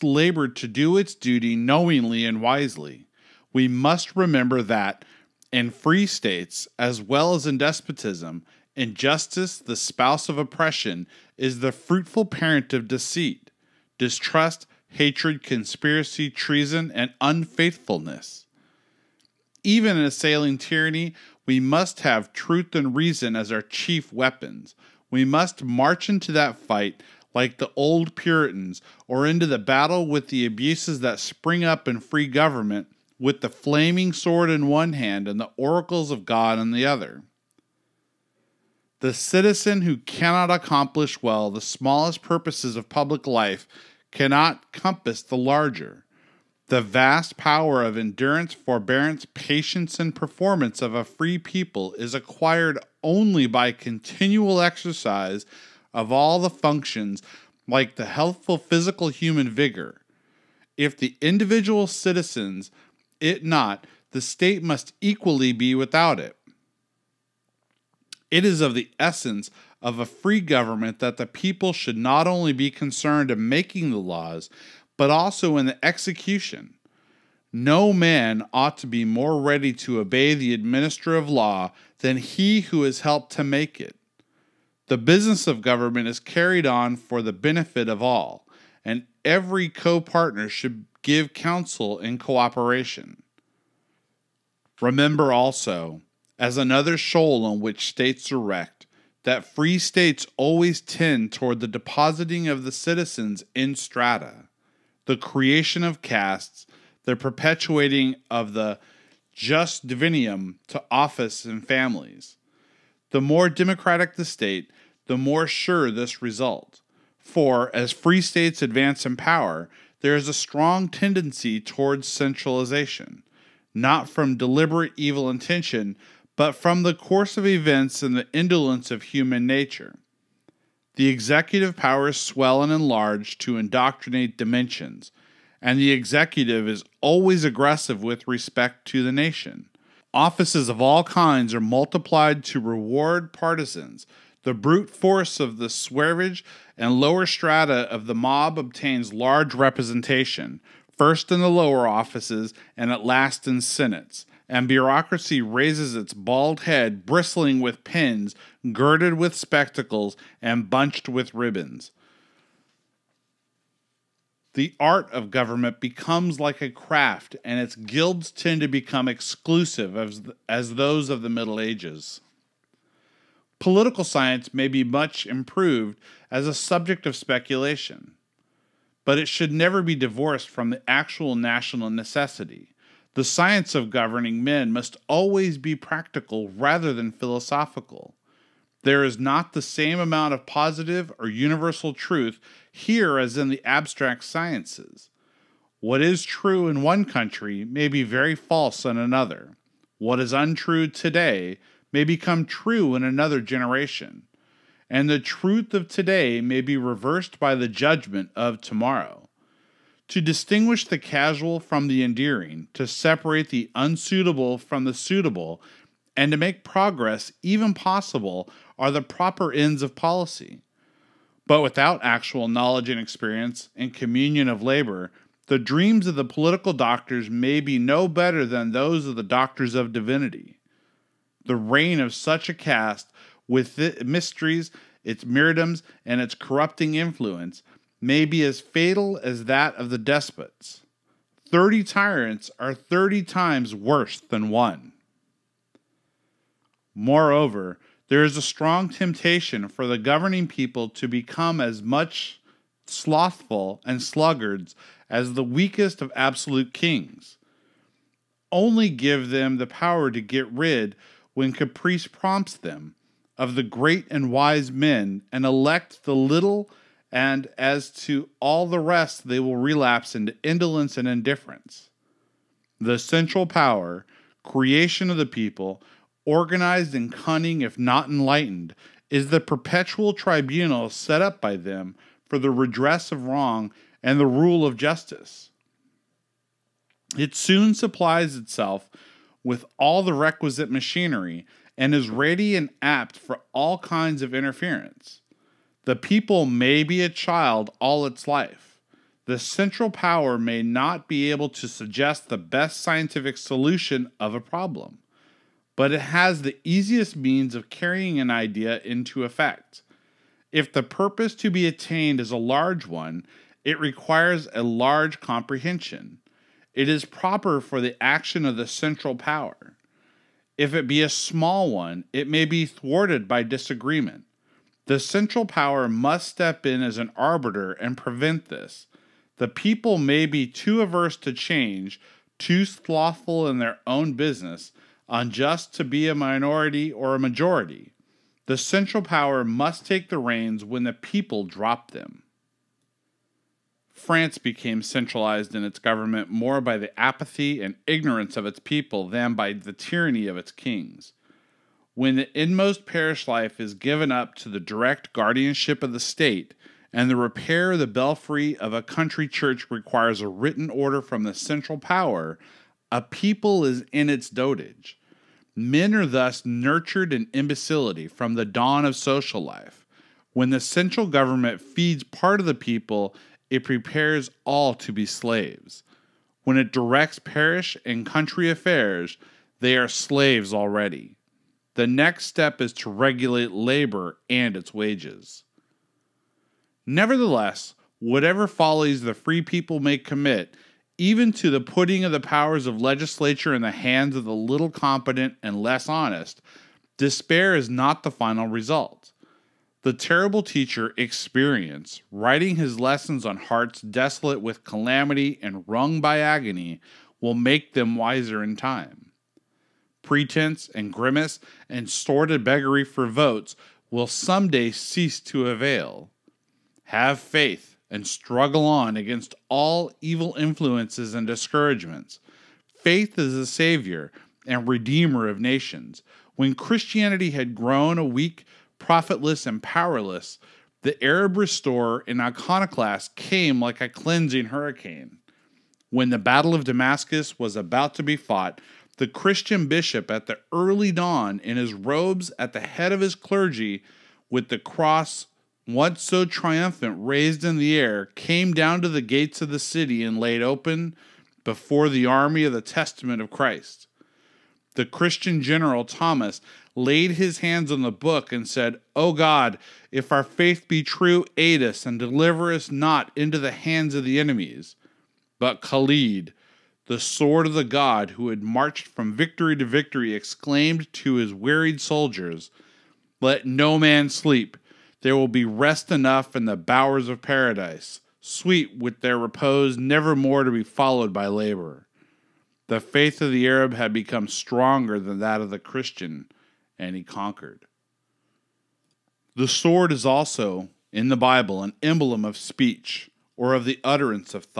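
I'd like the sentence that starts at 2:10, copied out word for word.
The executive powers swell and enlarge to indoctrinate dimensions, and the executive is always aggressive with respect to the nation.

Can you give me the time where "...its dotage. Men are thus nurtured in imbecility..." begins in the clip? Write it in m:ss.
6:04.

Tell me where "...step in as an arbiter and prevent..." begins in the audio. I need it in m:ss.
5:26.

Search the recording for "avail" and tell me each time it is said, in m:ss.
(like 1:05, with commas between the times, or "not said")
6:55.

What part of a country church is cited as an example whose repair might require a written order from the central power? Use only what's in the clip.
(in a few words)
the belfry.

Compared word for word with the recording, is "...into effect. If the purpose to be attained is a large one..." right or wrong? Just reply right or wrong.
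right.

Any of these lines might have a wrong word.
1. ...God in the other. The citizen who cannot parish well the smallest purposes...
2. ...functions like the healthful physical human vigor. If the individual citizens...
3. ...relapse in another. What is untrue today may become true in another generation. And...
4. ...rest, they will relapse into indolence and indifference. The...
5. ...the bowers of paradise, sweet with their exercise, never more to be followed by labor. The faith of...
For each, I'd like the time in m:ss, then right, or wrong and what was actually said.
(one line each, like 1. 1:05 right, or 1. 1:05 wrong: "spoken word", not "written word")
1. 0:36 wrong: "accomplish", not "parish"
2. 0:56 right
3. 3:18 wrong: "false", not "relapse"
4. 4:28 right
5. 7:56 wrong: "repose", not "exercise".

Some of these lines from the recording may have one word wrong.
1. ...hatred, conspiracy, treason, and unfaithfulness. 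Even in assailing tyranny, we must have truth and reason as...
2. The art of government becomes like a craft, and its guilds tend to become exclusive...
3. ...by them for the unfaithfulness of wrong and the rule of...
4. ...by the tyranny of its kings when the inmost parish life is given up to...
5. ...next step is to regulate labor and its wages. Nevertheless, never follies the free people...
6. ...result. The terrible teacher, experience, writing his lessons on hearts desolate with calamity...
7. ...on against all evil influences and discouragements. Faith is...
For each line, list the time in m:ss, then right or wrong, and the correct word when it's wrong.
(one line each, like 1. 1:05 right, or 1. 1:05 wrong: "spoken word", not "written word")
1. 0:14 right
2. 2:44 right
3. 4:41 wrong: "redress", not "unfaithfulness"
4. 5:49 right
5. 6:21 wrong: "whatever", not "never"
6. 6:38 right
7. 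6:58 right.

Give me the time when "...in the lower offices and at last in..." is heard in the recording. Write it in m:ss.
2:31.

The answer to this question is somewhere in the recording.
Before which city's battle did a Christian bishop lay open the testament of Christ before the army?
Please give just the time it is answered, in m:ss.
7:16.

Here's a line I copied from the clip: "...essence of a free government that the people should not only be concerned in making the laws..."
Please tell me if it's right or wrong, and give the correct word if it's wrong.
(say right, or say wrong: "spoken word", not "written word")
right.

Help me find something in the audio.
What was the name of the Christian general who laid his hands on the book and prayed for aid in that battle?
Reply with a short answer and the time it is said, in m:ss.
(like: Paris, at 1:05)
Thomas, at 7:35.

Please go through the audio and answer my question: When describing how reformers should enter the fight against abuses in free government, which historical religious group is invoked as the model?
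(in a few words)
the old Puritans.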